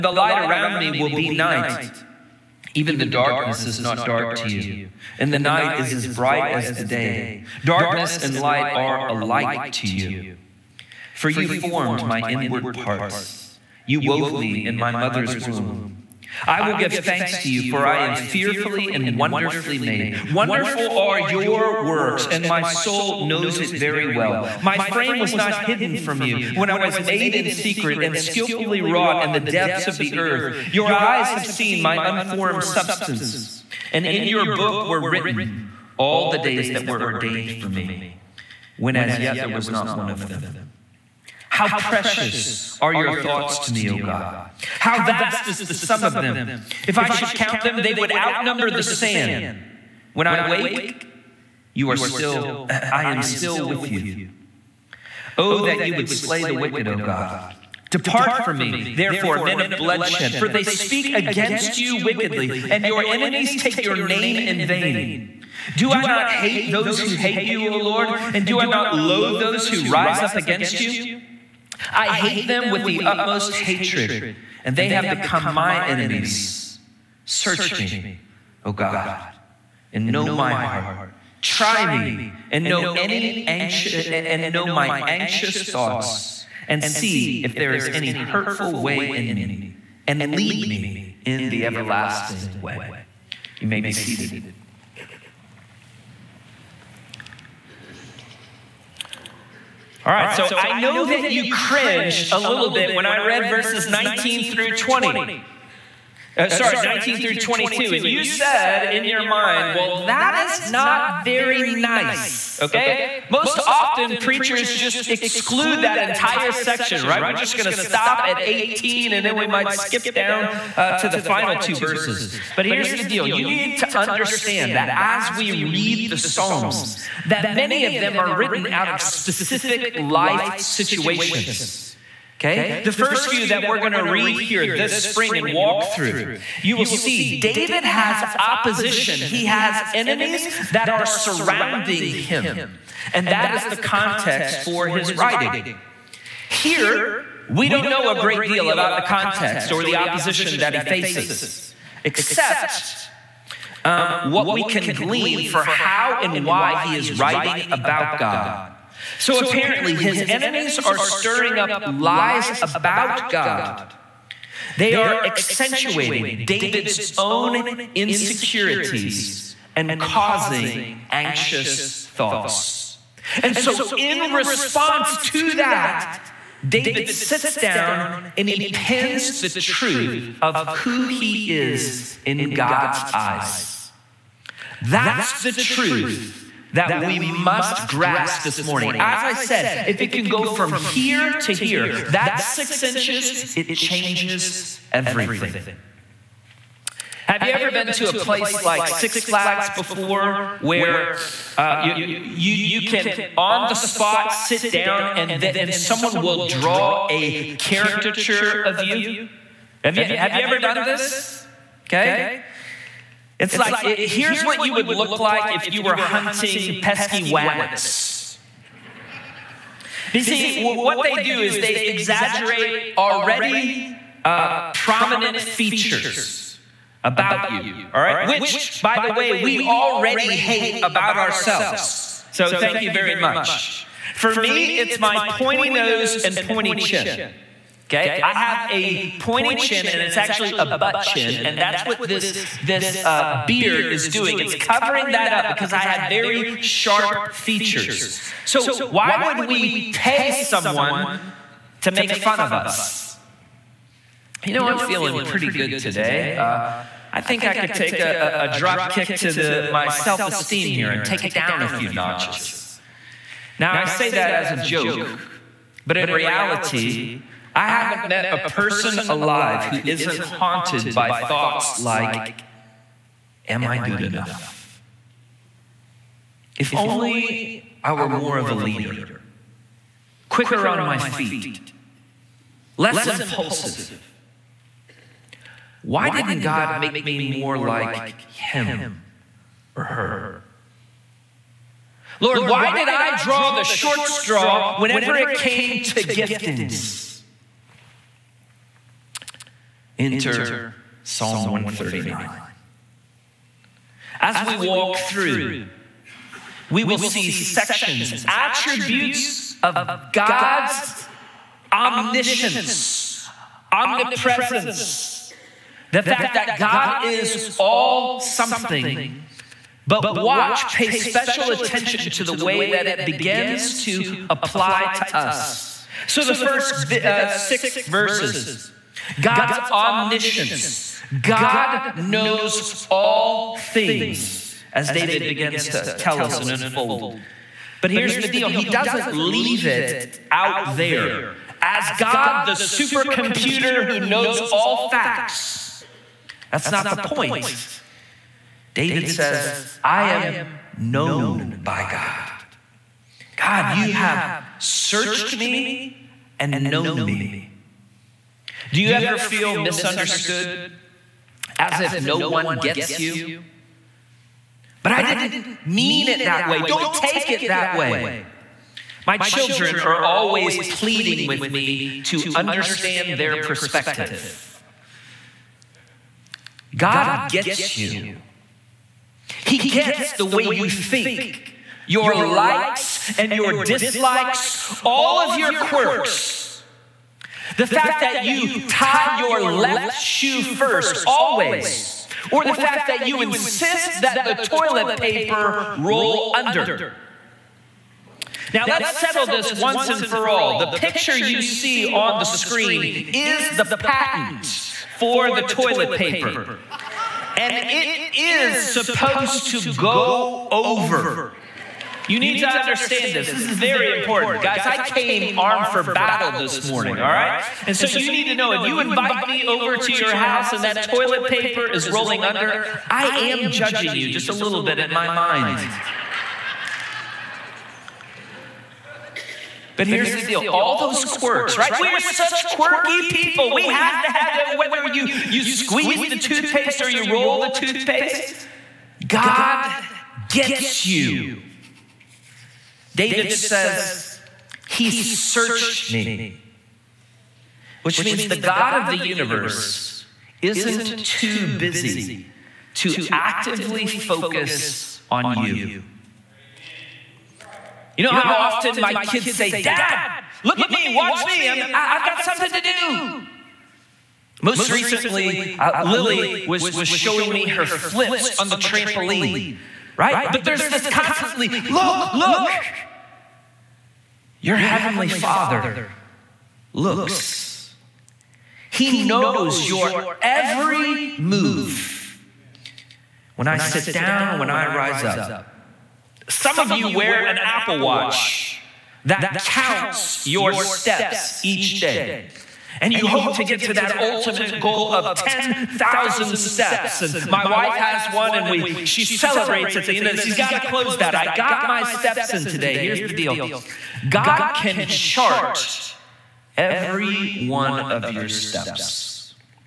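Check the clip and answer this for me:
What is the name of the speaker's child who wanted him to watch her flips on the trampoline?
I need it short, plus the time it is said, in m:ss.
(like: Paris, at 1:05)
Lily, at 7:45.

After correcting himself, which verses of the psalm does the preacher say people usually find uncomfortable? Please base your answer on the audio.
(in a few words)
19 through 22.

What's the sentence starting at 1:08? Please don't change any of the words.
And do I not loathe those who rise up against you?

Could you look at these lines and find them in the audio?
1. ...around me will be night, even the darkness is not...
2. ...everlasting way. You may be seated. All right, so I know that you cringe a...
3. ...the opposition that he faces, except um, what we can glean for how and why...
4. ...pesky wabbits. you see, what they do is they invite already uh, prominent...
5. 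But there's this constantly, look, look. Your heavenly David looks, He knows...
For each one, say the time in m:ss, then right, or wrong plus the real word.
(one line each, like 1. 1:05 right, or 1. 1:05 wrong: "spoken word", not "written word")
1. 0:00 right
2. 1:31 right
3. 2:29 right
4. 3:36 wrong: "exaggerate", not "invite"
5. 7:50 wrong: "Father", not "David".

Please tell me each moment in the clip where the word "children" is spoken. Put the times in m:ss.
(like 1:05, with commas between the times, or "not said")
6:09.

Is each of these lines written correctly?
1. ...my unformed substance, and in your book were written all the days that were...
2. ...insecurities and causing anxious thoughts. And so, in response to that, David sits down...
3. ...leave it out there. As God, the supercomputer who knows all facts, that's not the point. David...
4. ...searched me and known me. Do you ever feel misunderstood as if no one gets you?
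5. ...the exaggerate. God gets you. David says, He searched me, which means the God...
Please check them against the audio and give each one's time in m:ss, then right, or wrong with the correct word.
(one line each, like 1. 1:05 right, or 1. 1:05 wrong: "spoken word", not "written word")
1. 0:31 right
2. 2:47 right
3. 5:39 right
4. 5:54 right
5. 7:17 wrong: "toothpaste", not "exaggerate".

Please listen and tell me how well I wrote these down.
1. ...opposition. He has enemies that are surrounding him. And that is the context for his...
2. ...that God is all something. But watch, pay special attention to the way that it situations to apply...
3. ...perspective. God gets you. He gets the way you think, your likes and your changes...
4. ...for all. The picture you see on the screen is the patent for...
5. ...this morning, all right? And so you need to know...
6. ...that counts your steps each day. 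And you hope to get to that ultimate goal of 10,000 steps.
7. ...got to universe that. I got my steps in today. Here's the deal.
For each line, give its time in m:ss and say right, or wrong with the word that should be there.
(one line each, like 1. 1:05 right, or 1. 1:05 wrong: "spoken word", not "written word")
1. 2:18 right
2. 5:16 wrong: "begins", not "situations"
3. 6:13 wrong: "dislikes", not "changes"
4. 6:40 right
5. 6:56 right
6. 8:09 right
7. 8:20 wrong: "close", not "universe".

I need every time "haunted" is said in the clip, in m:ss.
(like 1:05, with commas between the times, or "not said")
4:30.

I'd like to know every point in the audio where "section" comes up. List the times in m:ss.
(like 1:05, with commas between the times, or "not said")
1:56, 5:07.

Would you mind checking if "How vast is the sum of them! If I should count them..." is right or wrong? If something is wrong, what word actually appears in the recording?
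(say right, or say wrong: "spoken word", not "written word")
right.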